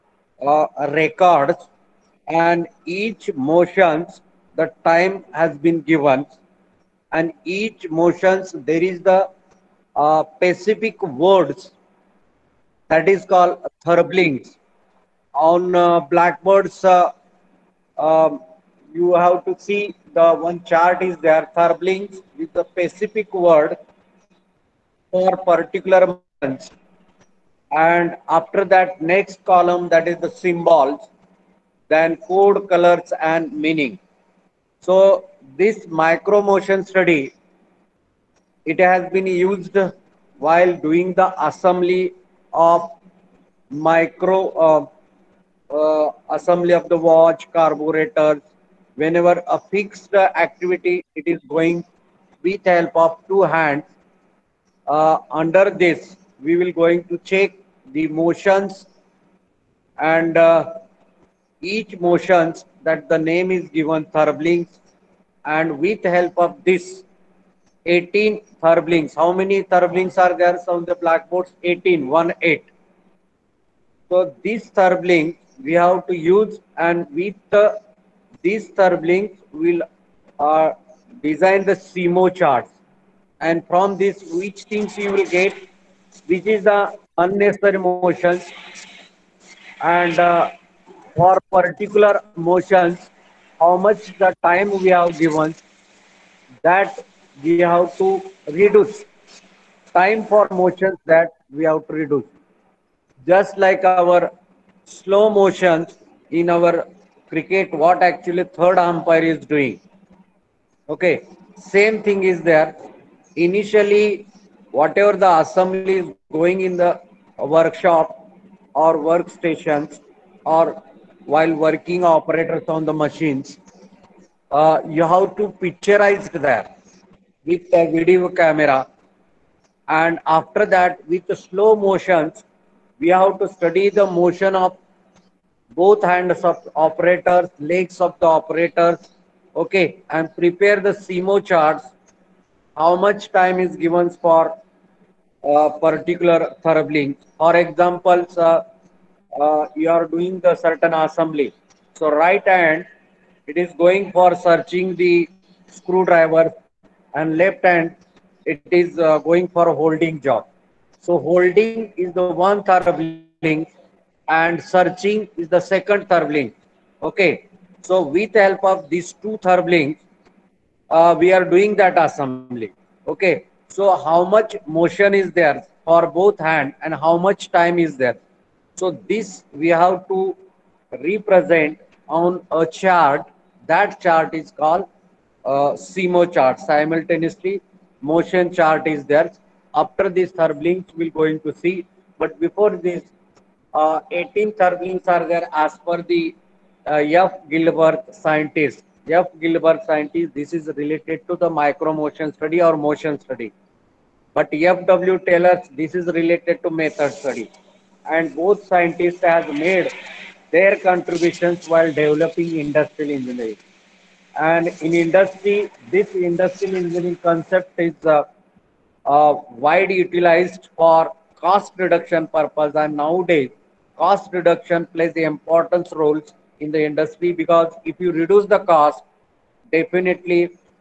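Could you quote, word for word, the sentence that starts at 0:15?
On uh, blackboards, uh, um, you have to see the one chart is there, thurblings with the specific word for particular months.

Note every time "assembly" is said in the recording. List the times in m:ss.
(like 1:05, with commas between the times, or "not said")
0:41, 0:46, 1:55, 2:30, 2:51.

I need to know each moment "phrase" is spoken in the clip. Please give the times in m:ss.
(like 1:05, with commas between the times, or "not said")
not said.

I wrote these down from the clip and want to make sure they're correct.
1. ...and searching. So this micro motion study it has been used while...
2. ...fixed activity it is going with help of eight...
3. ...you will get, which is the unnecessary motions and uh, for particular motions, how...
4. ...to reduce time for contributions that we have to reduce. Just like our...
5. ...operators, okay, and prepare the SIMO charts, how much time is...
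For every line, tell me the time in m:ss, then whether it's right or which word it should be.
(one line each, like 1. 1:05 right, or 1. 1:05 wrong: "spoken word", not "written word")
1. 0:33 wrong: "meaning", not "searching"
2. 0:49 wrong: "two", not "eight"
3. 1:24 right
4. 1:37 wrong: "motions", not "contributions"
5. 2:18 right.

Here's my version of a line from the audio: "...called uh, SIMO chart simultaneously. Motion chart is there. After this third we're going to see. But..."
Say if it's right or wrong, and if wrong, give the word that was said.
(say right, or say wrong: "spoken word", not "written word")
right.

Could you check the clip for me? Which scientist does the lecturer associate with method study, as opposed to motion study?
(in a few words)
F.W. Taylor.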